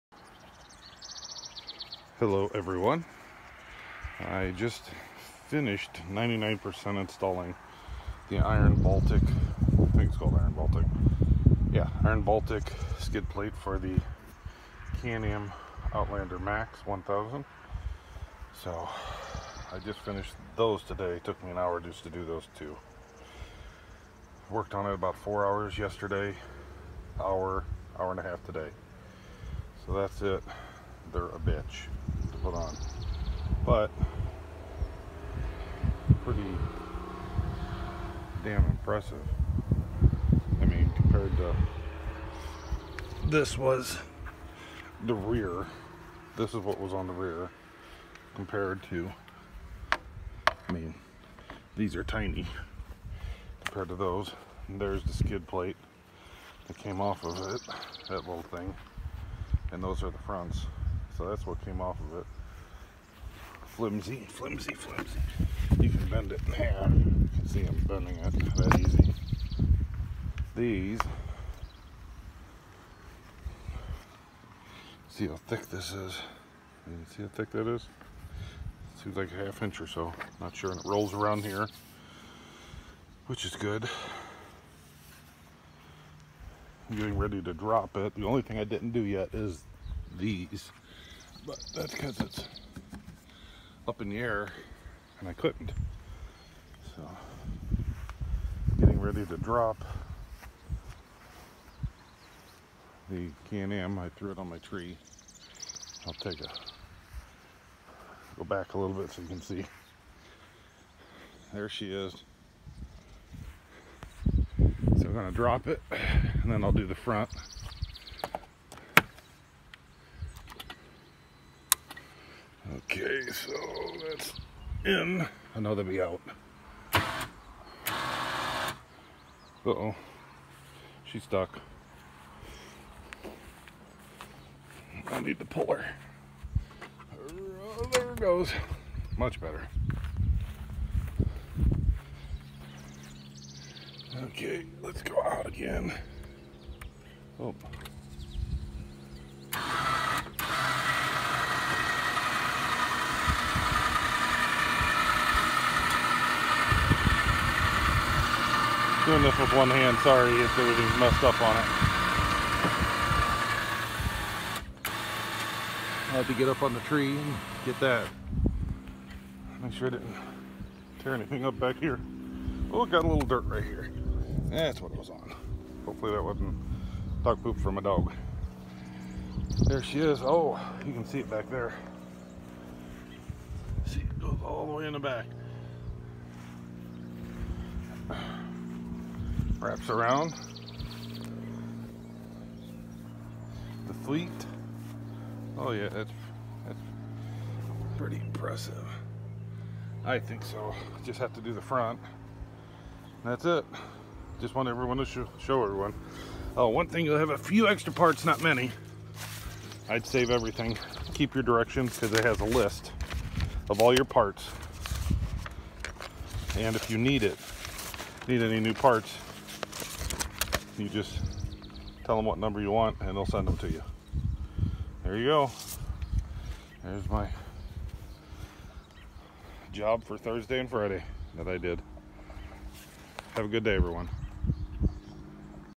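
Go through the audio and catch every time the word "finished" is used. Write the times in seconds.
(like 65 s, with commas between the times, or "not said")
5 s, 20 s.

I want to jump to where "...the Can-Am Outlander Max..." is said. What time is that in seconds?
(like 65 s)
13 s.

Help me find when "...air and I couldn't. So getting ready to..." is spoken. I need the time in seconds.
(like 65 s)
94 s.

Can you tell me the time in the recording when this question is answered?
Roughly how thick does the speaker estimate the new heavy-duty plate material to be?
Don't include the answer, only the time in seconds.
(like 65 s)
79 s.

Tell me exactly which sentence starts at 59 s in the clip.
And those are the fronts so that's what came off of it.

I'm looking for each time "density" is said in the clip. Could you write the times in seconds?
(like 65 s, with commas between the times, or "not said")
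not said.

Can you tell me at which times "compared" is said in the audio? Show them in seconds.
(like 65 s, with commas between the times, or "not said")
40 s, 48 s, 53 s.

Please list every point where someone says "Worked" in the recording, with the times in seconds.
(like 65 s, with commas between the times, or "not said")
24 s.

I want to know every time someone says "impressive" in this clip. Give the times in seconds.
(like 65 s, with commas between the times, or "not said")
38 s, 198 s.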